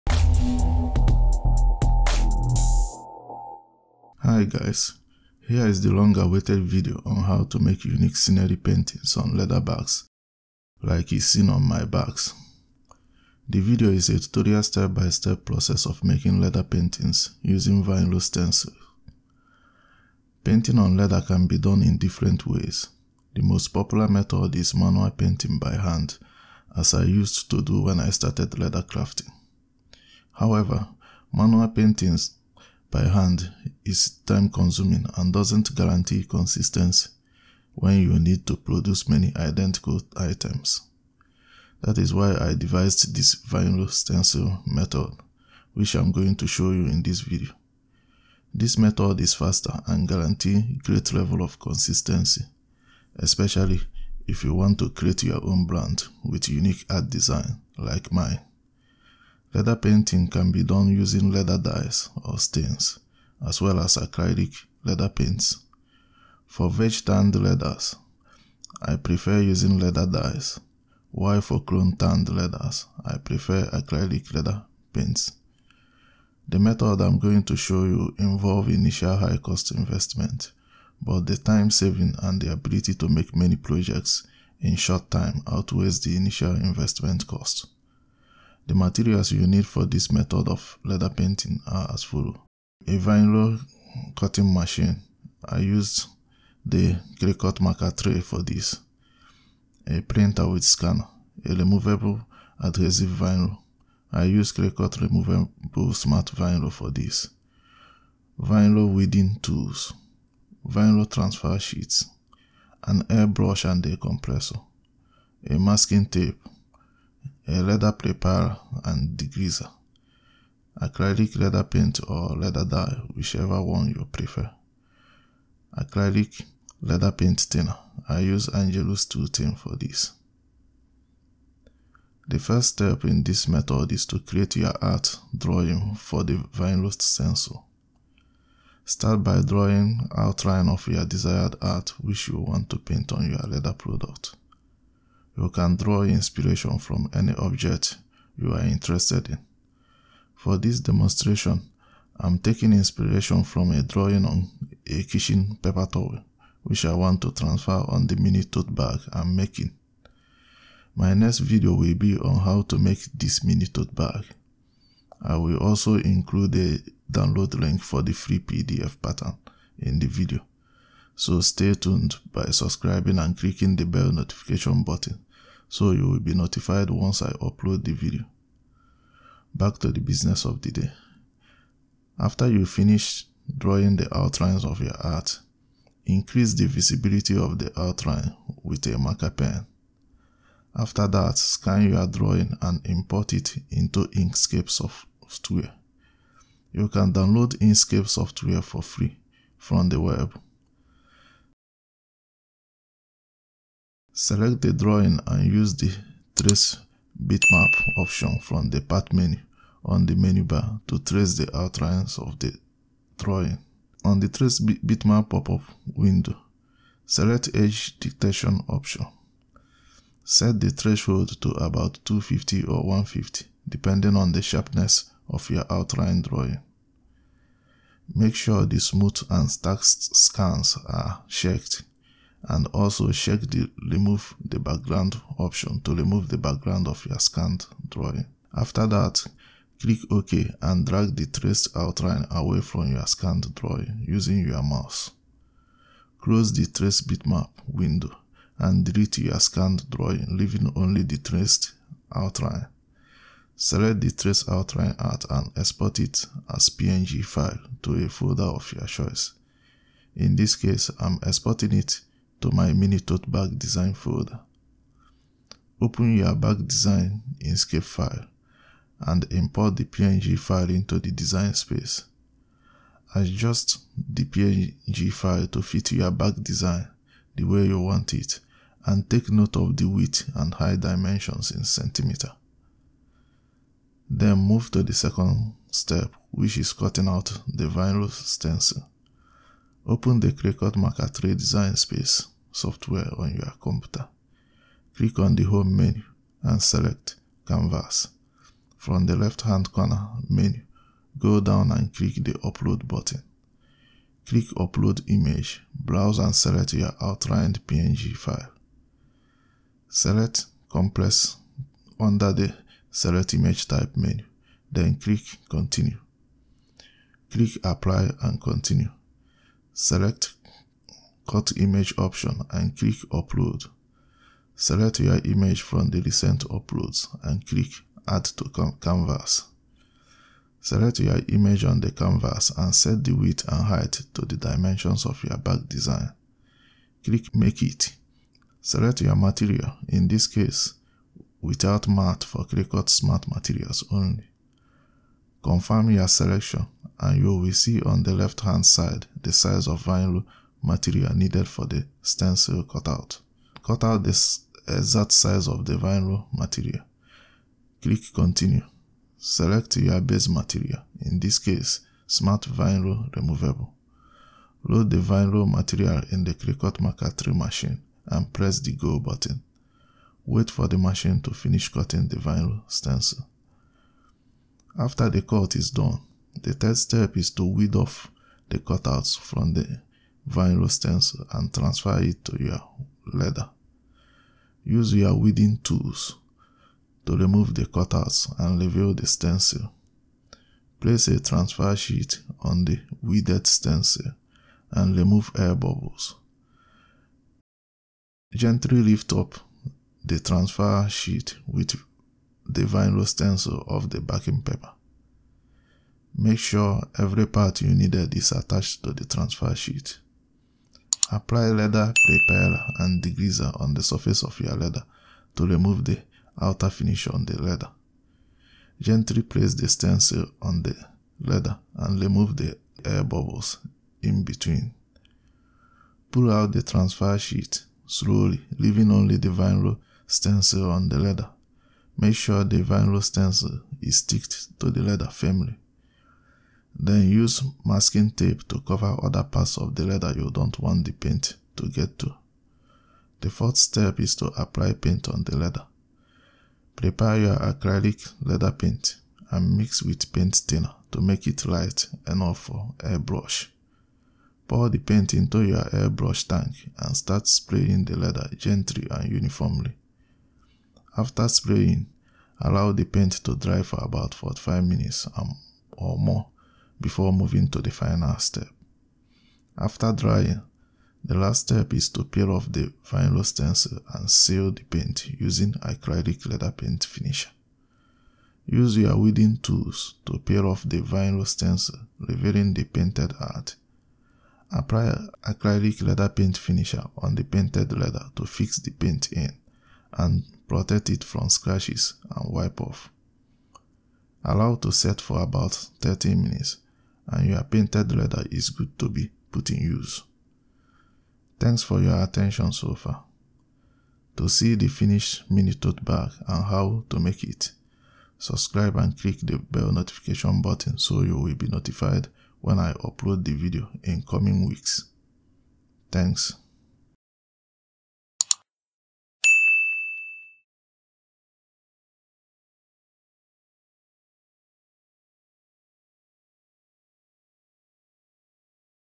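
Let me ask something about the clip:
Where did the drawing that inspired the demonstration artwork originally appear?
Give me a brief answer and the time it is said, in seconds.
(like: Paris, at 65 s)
Kitchen paper towel, at 155 s.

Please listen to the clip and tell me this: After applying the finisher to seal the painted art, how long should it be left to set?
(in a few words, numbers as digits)
30 minutes.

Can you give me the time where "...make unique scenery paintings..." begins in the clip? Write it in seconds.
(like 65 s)
7 s.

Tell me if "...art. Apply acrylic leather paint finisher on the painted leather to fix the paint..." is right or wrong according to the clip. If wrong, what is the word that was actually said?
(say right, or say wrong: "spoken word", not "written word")
right.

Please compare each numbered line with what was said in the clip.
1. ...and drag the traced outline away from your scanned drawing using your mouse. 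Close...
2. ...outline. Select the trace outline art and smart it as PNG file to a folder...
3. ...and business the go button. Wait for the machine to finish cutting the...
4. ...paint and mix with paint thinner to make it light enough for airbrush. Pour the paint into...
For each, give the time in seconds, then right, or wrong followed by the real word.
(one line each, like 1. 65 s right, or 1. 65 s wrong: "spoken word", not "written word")
1. 240 s right
2. 252 s wrong: "export", not "smart"
3. 368 s wrong: "press", not "business"
4. 448 s right.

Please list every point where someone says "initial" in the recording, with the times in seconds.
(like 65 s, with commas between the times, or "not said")
78 s, 86 s.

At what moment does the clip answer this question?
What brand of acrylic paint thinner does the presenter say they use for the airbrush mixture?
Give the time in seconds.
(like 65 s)
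128 s.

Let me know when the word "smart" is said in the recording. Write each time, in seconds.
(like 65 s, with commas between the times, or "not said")
105 s, 342 s, 362 s.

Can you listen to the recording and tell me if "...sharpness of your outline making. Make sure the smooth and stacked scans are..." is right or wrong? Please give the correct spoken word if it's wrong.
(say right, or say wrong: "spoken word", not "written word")
wrong: "drawing", not "making".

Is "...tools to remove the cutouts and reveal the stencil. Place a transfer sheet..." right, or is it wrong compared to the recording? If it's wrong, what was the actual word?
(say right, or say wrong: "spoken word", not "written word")
right.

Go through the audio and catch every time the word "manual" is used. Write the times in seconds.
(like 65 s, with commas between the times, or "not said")
24 s, 31 s.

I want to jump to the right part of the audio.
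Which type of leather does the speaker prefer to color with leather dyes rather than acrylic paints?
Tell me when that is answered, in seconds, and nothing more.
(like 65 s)
66 s.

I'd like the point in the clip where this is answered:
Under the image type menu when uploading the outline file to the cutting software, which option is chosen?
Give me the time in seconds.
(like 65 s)
310 s.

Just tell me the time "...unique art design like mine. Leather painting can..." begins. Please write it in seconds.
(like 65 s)
56 s.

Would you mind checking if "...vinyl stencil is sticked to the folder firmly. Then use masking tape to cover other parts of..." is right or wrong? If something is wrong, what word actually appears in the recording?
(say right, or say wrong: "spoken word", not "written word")
wrong: "leather", not "folder".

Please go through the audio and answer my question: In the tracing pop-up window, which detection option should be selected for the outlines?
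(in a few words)
Edge detection.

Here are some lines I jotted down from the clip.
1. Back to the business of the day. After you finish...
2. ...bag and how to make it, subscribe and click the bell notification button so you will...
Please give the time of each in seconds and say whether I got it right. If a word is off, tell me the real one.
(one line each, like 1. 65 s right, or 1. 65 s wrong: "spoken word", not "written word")
1. 179 s right
2. 505 s right.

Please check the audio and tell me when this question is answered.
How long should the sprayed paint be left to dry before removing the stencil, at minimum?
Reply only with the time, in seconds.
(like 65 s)
464 s.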